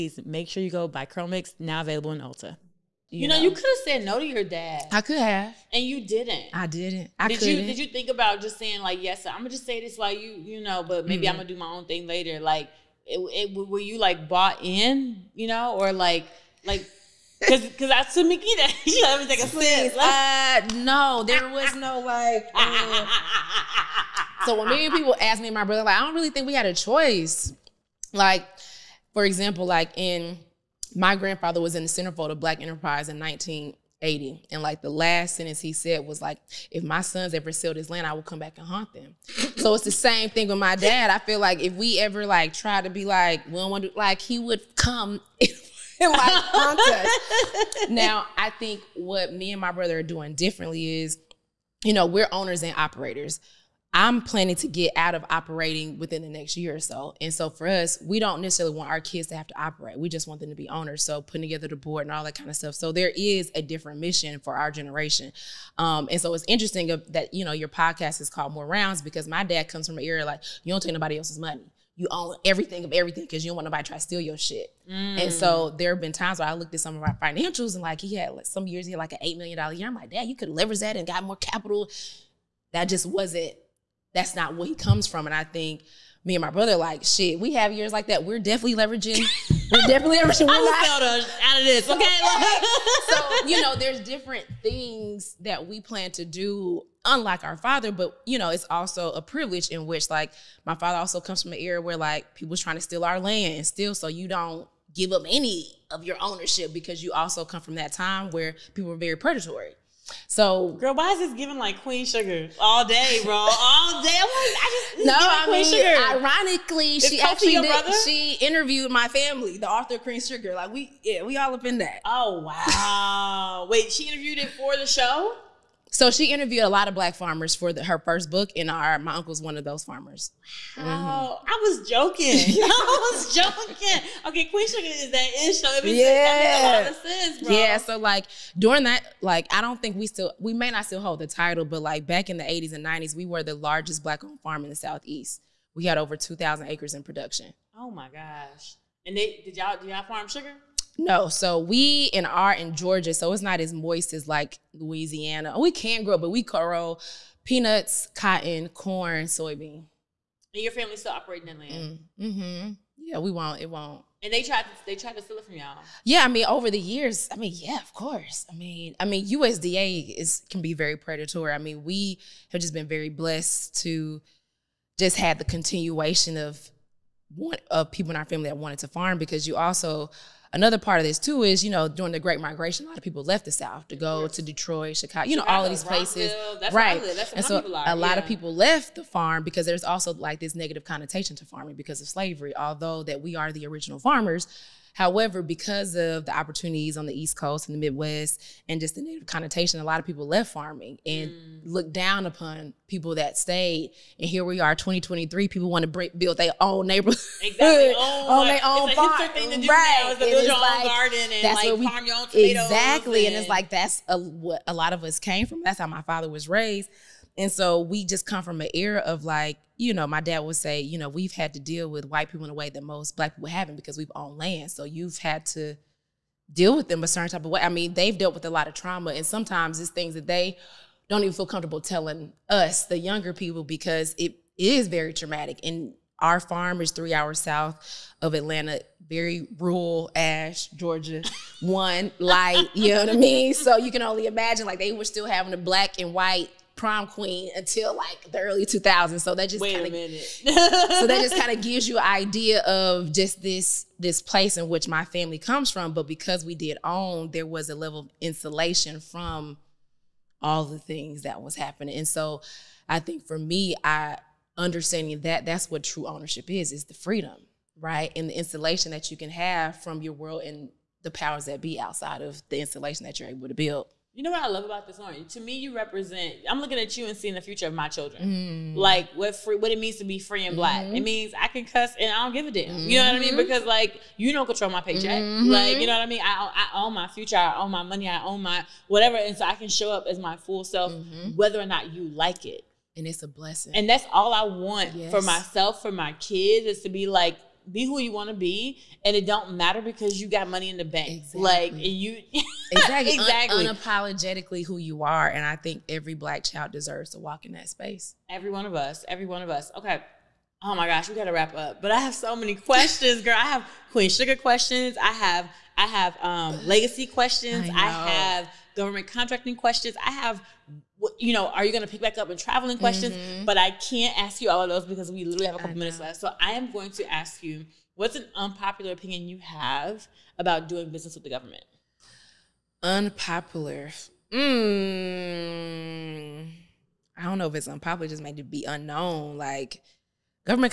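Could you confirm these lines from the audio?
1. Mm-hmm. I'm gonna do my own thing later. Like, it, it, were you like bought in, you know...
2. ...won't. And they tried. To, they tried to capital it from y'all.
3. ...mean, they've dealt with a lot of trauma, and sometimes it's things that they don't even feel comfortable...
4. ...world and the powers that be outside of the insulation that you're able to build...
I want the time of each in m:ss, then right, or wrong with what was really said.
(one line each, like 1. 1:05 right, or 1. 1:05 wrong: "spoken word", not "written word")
1. 0:11 right
2. 2:43 wrong: "steal", not "capital"
3. 3:47 right
4. 4:30 right.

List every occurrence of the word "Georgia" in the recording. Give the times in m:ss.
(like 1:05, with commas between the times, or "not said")
2:32, 4:00.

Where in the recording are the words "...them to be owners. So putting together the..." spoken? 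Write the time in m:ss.
1:00.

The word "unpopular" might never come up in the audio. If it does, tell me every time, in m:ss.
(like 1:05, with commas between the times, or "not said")
5:28, 5:32, 5:37.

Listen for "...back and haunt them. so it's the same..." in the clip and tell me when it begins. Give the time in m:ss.
0:38.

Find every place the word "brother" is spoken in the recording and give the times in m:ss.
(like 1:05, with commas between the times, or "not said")
0:25, 0:49, 1:26.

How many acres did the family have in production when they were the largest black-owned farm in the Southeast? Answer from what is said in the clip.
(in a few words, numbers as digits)
over 2,000.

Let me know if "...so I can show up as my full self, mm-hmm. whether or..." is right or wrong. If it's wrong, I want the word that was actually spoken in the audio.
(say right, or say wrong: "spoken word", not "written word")
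right.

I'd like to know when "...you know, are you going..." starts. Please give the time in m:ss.
5:21.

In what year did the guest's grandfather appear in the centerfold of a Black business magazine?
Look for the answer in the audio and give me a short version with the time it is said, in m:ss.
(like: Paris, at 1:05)
1980, at 0:33.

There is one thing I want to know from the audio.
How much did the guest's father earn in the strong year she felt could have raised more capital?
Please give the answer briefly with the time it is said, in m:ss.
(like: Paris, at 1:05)
8 million dollars, at 1:19.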